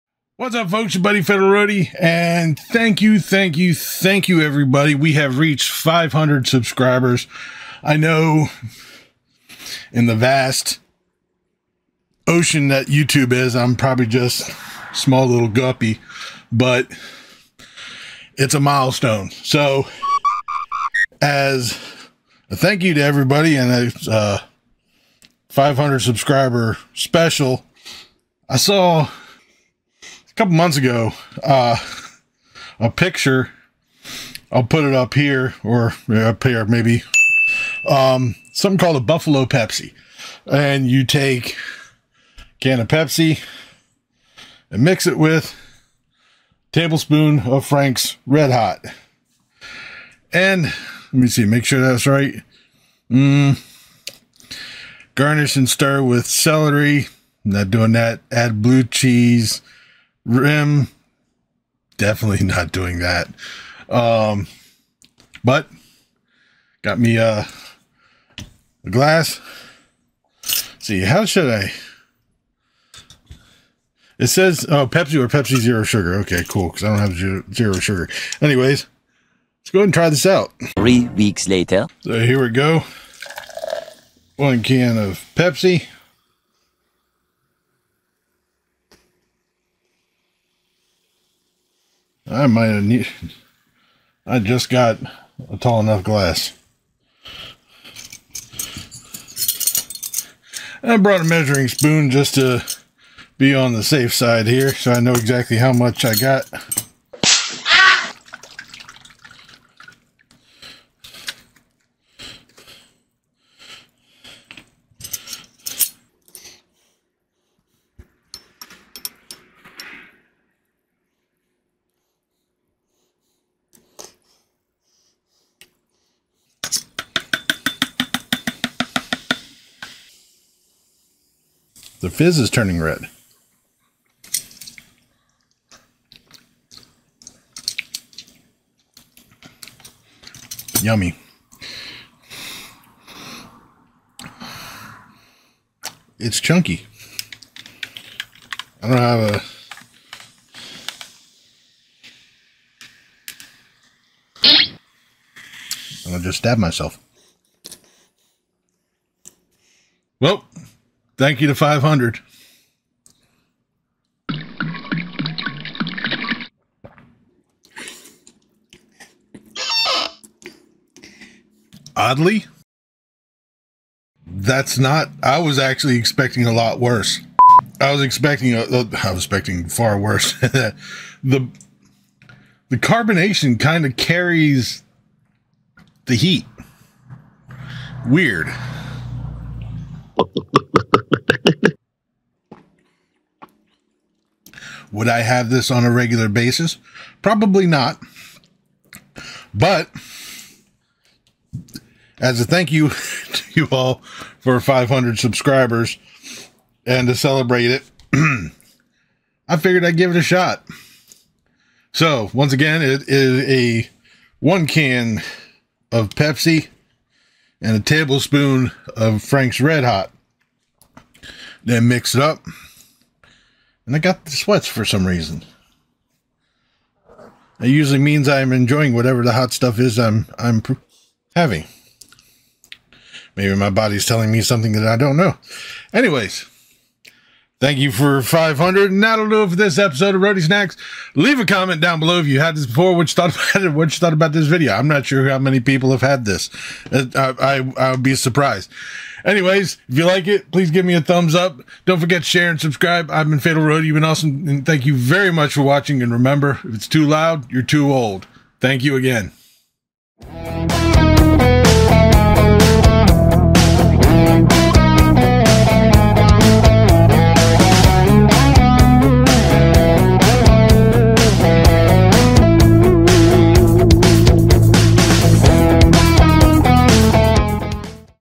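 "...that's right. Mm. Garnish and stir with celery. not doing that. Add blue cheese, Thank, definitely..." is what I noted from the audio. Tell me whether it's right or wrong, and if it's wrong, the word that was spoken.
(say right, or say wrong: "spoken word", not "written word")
wrong: "Rim", not "Thank".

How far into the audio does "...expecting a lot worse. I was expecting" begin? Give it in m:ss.
2:55.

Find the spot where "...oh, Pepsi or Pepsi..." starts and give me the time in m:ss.
1:14.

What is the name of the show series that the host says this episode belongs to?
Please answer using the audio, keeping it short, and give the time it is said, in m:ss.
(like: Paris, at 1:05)
Roadie Snacks, at 4:00.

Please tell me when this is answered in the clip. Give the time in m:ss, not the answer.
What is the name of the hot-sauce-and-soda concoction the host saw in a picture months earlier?
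0:39.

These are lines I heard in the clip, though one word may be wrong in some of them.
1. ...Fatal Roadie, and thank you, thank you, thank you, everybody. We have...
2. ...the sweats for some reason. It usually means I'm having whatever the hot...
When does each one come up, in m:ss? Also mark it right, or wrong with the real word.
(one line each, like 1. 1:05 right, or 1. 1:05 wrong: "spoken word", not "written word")
1. 0:01 right
2. 3:44 wrong: "enjoying", not "having".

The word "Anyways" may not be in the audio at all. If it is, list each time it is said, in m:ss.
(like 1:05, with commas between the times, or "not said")
1:18, 3:55, 4:09.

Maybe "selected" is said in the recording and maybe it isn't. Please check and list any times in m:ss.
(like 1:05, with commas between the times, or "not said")
not said.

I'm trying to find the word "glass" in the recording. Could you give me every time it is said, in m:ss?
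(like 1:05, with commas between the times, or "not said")
1:08, 1:36.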